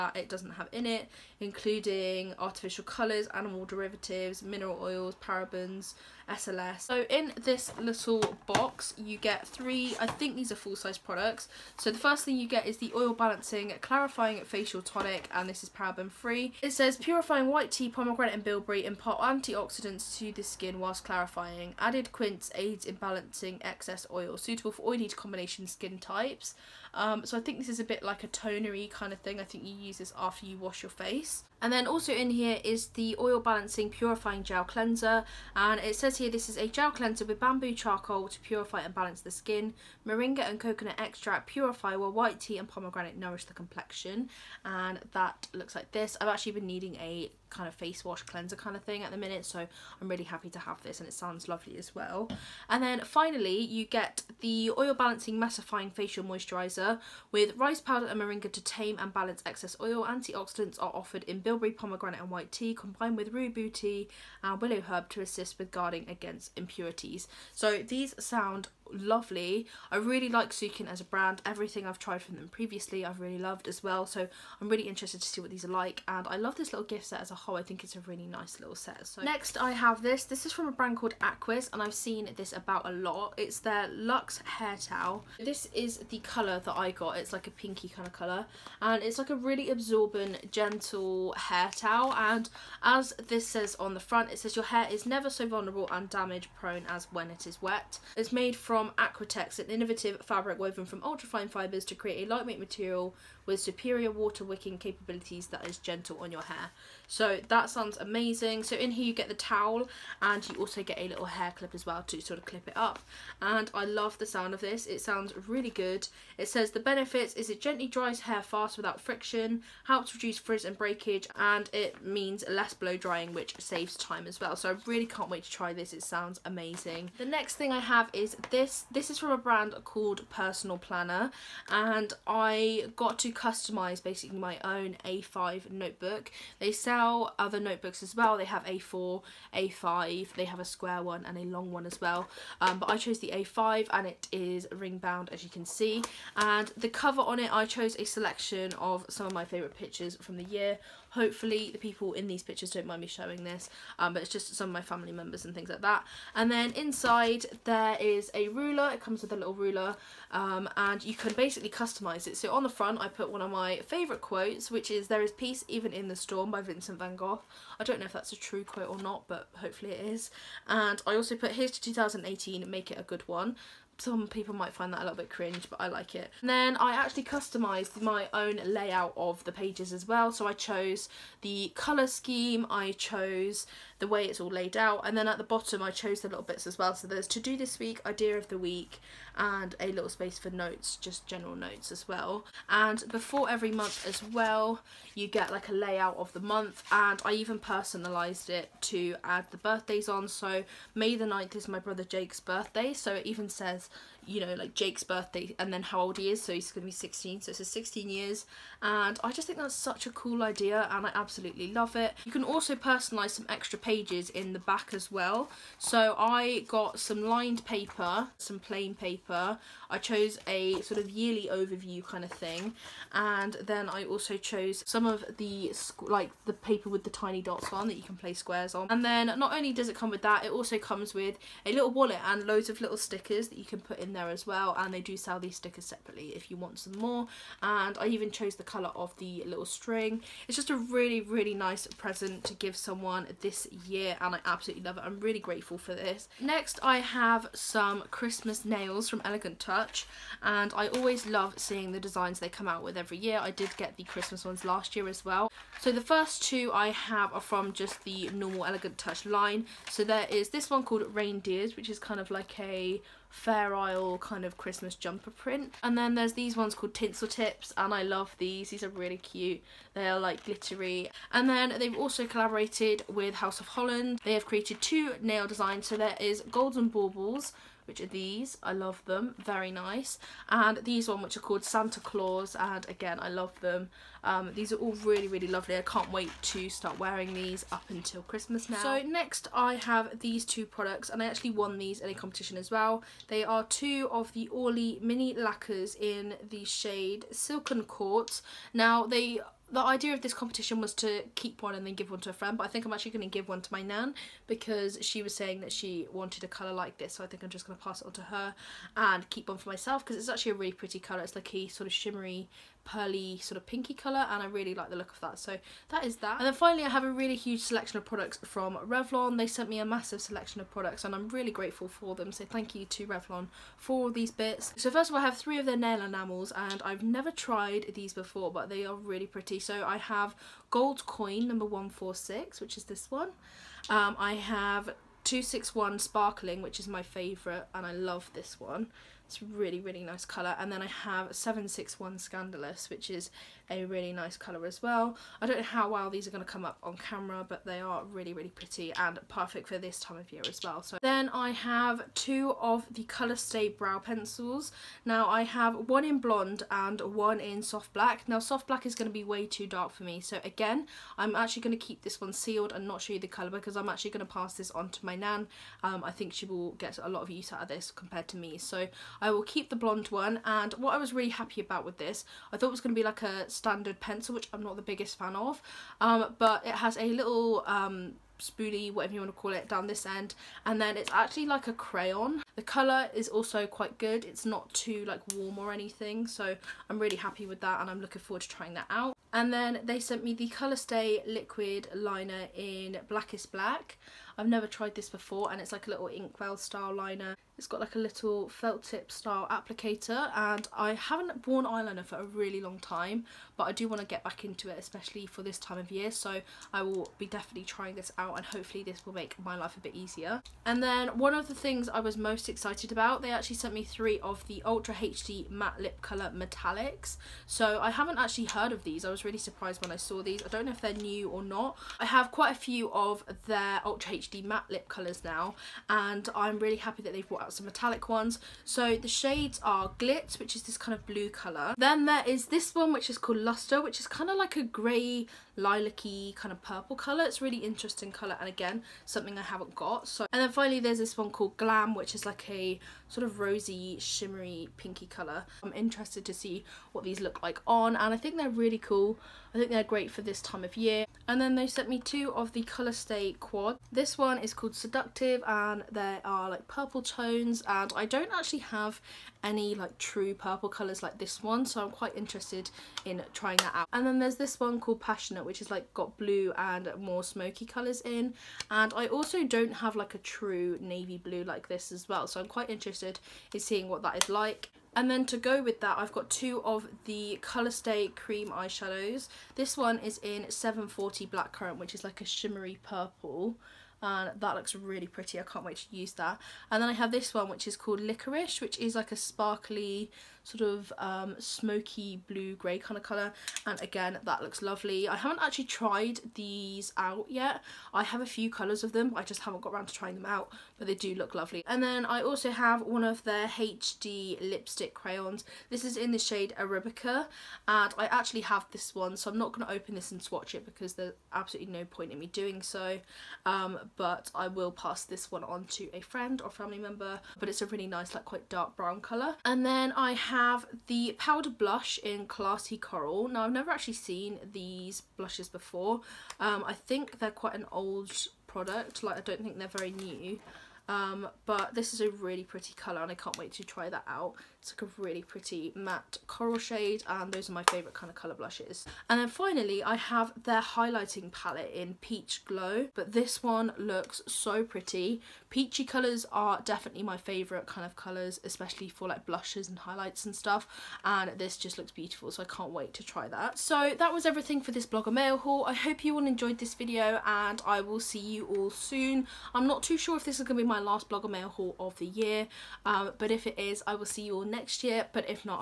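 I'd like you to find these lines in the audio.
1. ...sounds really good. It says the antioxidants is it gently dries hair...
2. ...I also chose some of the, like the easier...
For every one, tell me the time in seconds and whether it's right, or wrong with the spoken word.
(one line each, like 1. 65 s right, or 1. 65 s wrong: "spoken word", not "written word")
1. 115 s wrong: "benefits", not "antioxidants"
2. 223 s wrong: "paper", not "easier".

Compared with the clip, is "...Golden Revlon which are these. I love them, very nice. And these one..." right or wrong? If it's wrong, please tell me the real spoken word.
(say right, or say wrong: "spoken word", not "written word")
wrong: "Baubles", not "Revlon".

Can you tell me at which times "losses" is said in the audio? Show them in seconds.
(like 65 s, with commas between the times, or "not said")
not said.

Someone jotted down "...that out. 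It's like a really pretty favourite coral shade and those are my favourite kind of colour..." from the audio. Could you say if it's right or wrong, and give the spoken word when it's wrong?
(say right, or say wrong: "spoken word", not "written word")
wrong: "matte", not "favourite".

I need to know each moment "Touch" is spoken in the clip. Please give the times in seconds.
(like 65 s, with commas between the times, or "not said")
249 s, 258 s.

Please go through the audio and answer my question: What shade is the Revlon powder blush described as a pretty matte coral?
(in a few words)
Classy Coral.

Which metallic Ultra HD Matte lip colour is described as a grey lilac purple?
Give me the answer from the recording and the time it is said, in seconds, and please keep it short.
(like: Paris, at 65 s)
Luster, at 433 s.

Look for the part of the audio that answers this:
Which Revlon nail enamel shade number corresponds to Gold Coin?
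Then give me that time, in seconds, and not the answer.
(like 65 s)
331 s.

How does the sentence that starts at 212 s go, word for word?
You can also personalize some extra pages in the back as well.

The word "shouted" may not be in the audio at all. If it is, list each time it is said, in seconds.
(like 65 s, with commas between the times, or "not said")
not said.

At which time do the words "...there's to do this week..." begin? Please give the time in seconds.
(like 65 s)
187 s.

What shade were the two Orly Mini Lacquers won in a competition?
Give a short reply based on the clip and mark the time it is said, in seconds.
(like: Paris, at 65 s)
Silken Quartz, at 297 s.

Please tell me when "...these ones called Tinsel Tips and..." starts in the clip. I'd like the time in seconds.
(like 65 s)
266 s.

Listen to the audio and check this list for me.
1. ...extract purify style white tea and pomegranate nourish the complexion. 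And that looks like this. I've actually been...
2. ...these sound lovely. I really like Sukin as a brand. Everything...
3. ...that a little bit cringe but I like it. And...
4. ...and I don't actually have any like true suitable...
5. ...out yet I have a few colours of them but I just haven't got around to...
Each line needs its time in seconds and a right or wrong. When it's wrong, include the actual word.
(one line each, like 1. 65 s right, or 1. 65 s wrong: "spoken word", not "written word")
1. 40 s wrong: "while", not "style"
2. 67 s right
3. 174 s right
4. 457 s wrong: "purple", not "suitable"
5. 496 s right.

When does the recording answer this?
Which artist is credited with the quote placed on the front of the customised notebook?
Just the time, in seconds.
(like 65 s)
166 s.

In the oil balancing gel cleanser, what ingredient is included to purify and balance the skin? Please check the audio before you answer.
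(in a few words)
bamboo charcoal.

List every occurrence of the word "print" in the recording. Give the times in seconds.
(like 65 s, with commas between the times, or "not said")
265 s.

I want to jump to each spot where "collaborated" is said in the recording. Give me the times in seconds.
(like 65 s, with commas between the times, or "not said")
272 s.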